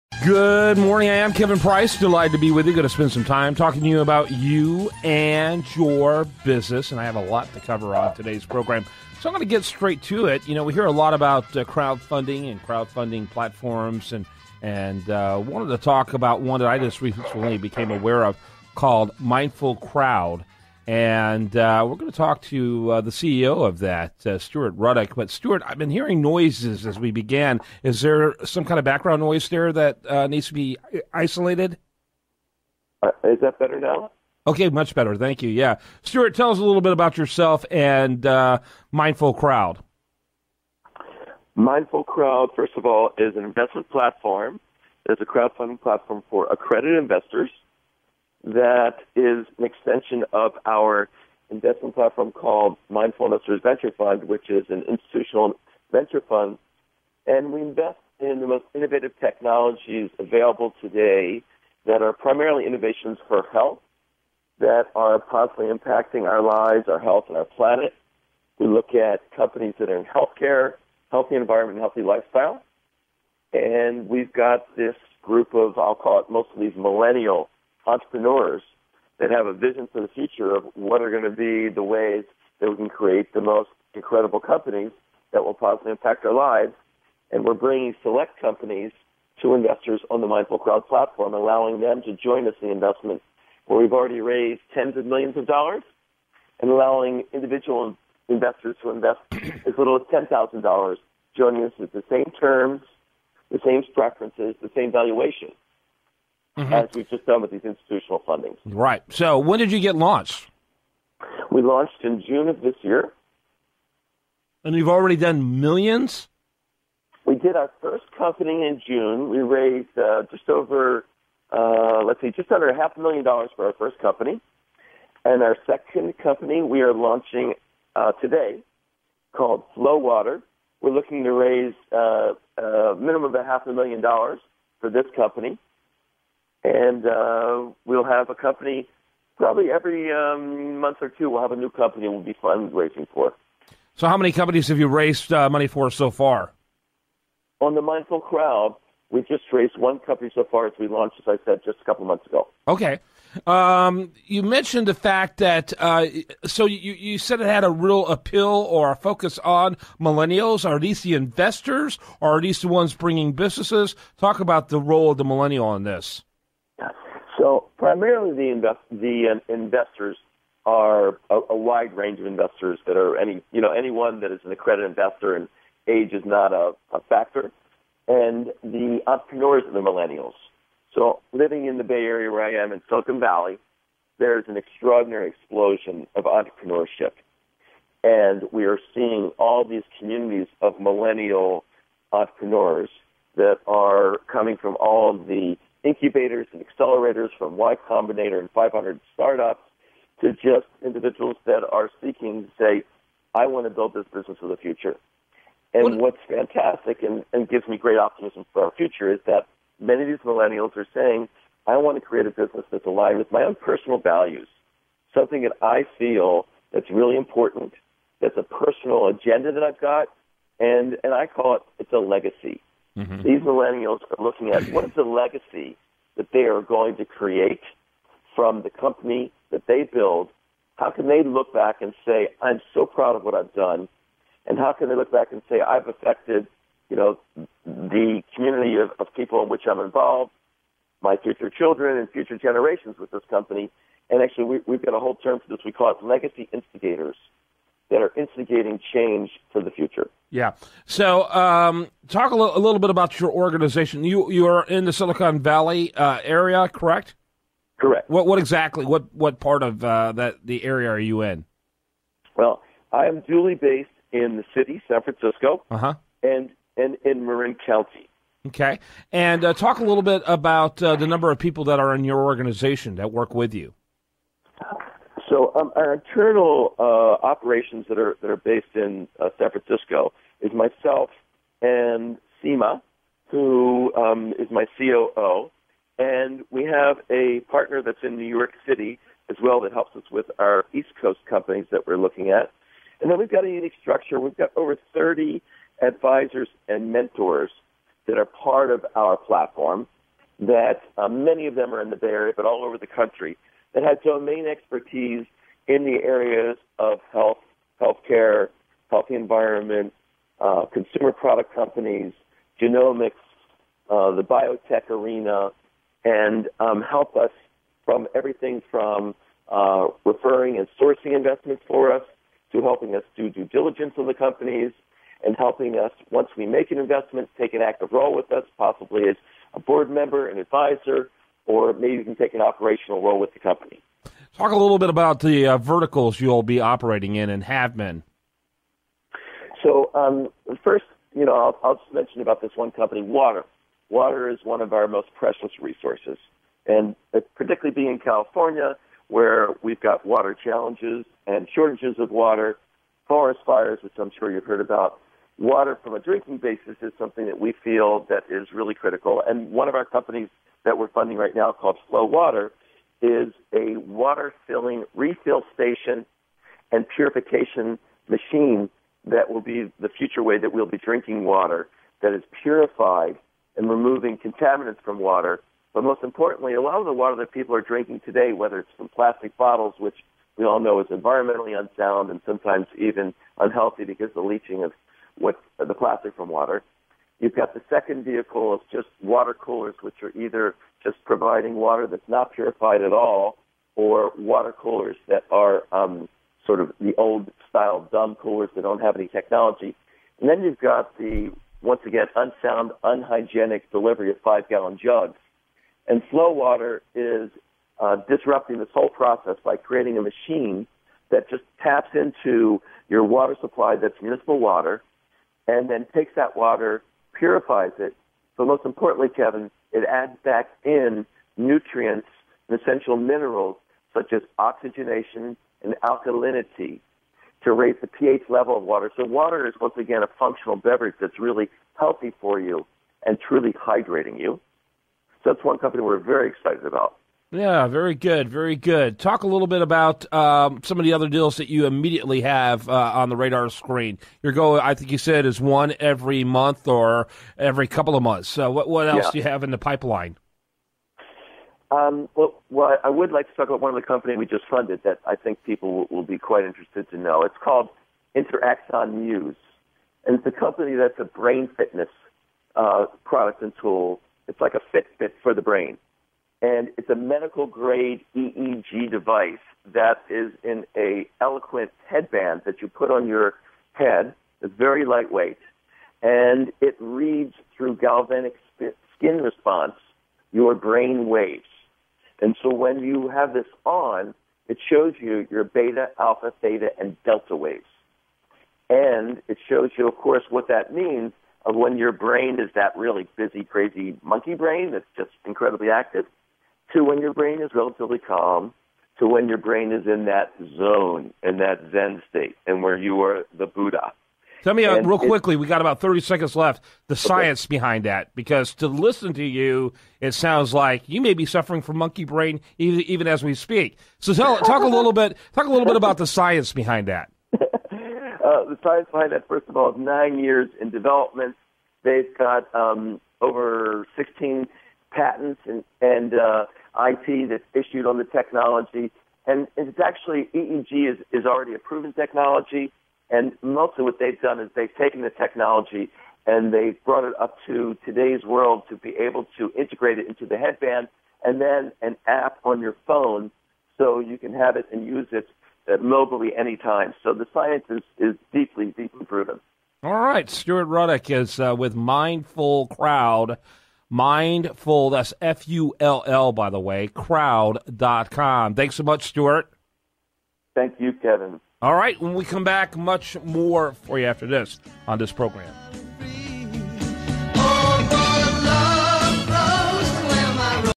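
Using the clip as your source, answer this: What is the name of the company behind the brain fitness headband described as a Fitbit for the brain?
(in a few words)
Interaxon Muse.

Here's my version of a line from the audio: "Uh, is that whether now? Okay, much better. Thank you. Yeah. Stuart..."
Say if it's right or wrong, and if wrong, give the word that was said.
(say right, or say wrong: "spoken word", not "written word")
wrong: "better", not "whether".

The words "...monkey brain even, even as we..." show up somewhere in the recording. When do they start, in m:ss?
8:31.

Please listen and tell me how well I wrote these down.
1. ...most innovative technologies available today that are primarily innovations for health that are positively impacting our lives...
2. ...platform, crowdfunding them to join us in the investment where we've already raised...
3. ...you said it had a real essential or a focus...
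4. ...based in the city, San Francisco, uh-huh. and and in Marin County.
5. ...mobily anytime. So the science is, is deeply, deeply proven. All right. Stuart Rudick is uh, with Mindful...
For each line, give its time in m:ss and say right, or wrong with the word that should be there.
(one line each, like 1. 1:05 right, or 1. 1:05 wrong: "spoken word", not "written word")
1. 0:58 right
2. 1:30 wrong: "allowing", not "crowdfunding"
3. 2:36 wrong: "appeal", not "essential"
4. 4:23 right
5. 9:05 right.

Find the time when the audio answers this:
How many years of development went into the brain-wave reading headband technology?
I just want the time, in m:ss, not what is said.
8:39.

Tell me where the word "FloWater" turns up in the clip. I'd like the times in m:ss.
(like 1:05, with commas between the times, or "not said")
2:09, 6:01, 6:46.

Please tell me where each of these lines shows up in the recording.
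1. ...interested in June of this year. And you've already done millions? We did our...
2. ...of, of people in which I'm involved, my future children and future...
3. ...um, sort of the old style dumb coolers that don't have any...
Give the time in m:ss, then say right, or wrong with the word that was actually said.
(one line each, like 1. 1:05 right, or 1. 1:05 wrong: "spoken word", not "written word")
1. 1:51 wrong: "launched", not "interested"
2. 3:58 right
3. 6:35 right.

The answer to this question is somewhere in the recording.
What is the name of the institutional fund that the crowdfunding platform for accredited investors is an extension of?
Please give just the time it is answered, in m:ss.
0:52.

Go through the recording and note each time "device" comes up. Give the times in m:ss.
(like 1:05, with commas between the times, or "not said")
7:48.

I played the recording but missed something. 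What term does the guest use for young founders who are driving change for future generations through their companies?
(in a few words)
legacy instigators.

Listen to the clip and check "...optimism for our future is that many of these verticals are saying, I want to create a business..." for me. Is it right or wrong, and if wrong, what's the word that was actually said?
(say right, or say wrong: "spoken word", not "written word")
wrong: "millennials", not "verticals".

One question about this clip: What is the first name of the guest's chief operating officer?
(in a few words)
Sima.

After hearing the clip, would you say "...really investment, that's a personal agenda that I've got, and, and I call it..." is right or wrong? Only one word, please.
wrong.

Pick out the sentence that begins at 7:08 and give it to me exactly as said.
So water is once again a functional beverage that's really healthy for you and truly hydrating you.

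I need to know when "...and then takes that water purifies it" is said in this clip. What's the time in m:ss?
6:55.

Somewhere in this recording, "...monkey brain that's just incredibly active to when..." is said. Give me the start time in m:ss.
8:14.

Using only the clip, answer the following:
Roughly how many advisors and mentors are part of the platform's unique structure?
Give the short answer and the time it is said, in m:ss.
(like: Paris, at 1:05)
over 30, at 4:54.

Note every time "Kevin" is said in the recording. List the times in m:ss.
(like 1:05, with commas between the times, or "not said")
0:01, 6:59, 9:20.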